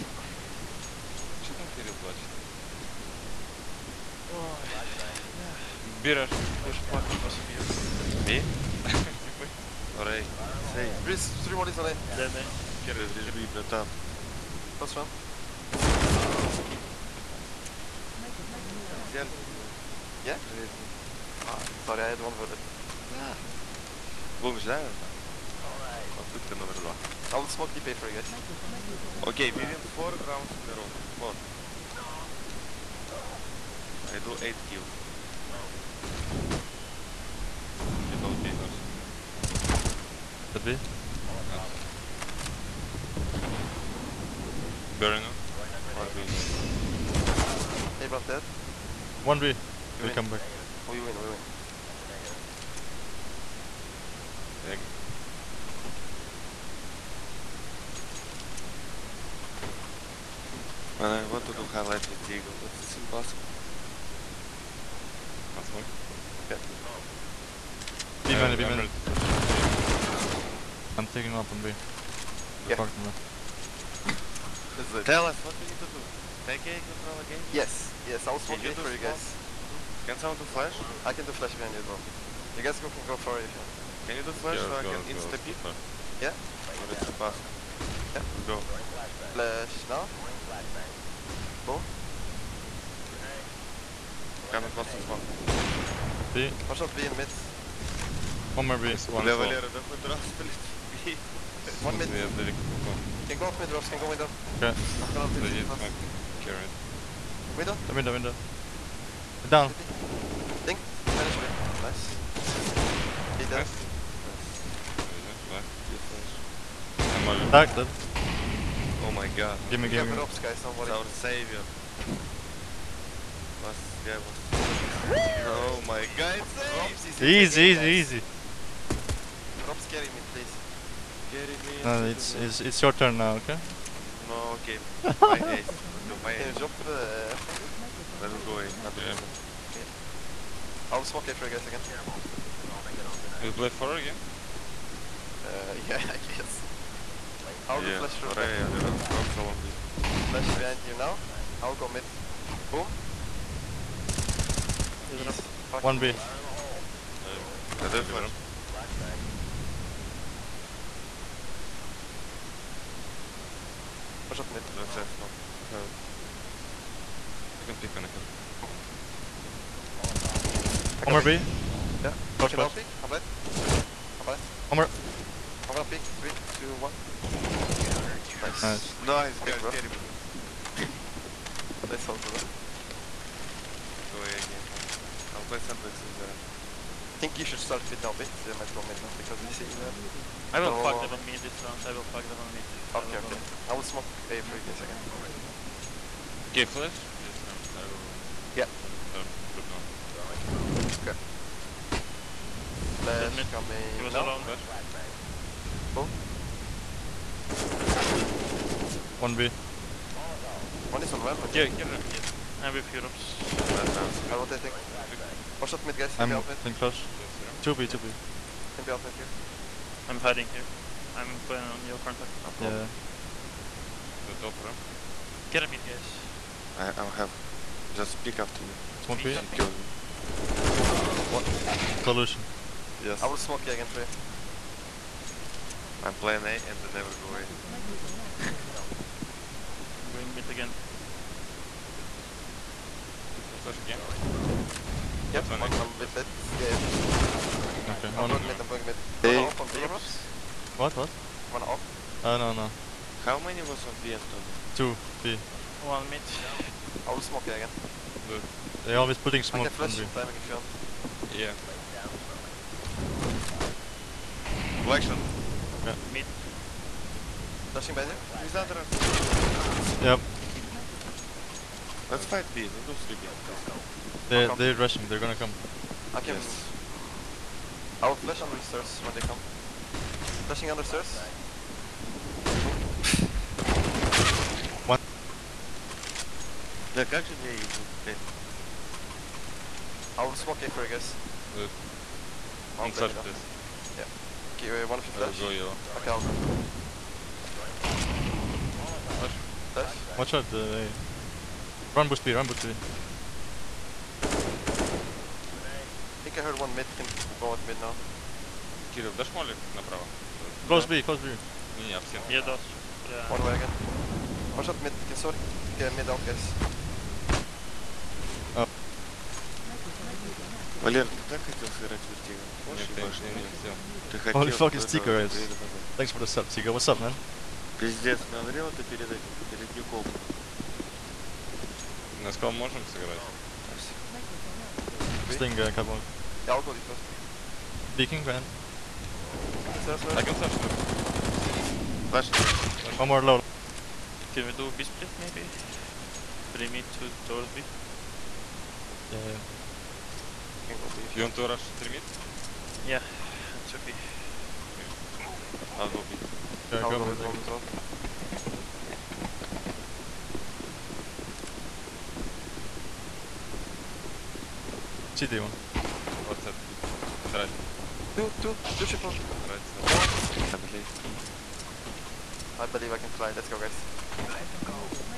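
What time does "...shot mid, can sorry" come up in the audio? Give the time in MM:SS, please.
05:14.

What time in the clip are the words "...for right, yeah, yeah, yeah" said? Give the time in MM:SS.
02:28.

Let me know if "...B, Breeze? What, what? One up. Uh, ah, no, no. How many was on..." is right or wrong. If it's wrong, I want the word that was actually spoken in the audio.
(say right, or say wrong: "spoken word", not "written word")
wrong: "Robs", not "Breeze".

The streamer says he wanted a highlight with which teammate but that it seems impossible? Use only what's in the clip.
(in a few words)
Diego.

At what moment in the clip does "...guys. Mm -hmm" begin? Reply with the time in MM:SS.
01:18.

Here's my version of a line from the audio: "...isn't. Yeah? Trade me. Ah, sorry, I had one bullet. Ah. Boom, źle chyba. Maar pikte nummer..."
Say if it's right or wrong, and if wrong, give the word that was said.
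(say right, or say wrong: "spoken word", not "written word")
right.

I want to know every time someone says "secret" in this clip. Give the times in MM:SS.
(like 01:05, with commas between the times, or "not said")
not said.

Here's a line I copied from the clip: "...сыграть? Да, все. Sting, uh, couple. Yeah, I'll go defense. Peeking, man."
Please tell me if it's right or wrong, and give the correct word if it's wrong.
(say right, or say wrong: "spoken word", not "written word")
right.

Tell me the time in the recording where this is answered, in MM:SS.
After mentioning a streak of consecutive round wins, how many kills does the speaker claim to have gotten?
00:34.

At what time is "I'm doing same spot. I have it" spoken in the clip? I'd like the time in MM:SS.
02:44.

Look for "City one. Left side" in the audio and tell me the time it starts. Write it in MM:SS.
06:05.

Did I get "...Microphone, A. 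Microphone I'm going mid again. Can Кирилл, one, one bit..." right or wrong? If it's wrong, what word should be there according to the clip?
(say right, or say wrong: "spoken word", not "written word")
wrong: "Yep", not "Кирилл".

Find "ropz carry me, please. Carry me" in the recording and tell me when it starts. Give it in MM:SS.
02:09.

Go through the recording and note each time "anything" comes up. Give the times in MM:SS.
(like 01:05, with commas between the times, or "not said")
03:34.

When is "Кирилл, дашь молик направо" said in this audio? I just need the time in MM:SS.
05:08.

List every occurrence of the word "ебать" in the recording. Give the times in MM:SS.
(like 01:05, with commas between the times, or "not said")
05:22.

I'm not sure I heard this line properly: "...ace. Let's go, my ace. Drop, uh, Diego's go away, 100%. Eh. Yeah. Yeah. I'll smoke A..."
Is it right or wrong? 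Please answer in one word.
wrong.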